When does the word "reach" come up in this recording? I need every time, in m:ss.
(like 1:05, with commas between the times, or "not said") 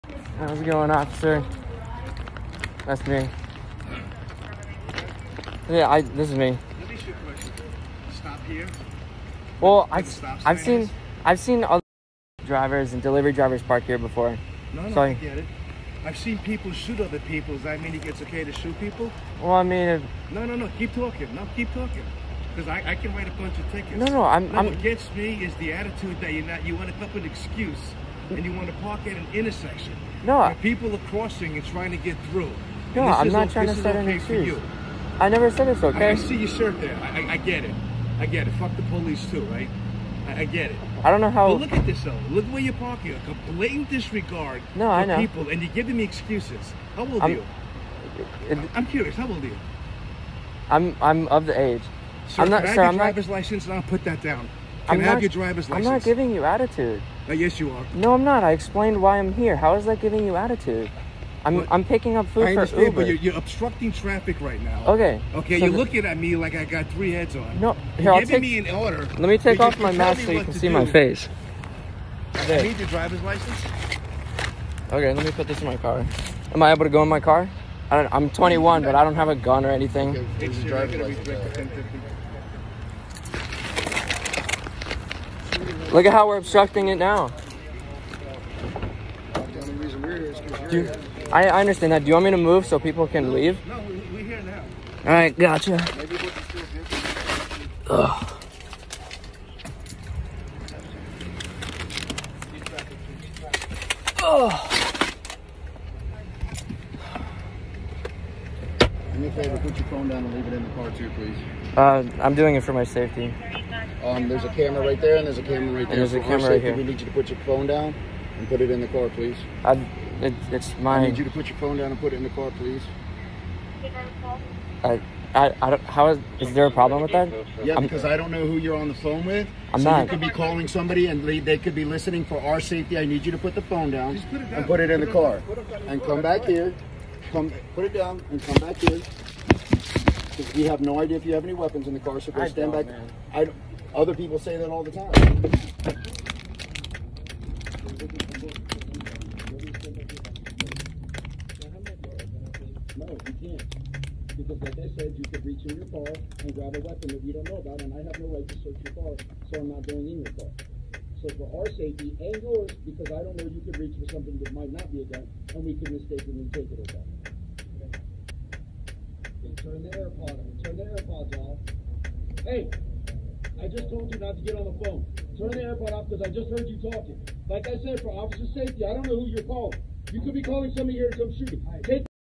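2:35, 2:43.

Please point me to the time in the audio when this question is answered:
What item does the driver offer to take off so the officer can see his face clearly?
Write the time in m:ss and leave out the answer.
1:09.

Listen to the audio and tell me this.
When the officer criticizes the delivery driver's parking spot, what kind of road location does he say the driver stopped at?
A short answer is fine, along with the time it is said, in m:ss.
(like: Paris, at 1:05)
Intersection, at 0:29.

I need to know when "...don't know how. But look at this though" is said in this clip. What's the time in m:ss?
0:41.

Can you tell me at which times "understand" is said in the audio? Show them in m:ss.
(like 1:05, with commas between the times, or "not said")
1:02, 1:31.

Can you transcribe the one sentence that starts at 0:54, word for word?
Can I'm I have not, your driver's license?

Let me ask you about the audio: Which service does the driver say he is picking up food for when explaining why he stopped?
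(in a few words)
Uber.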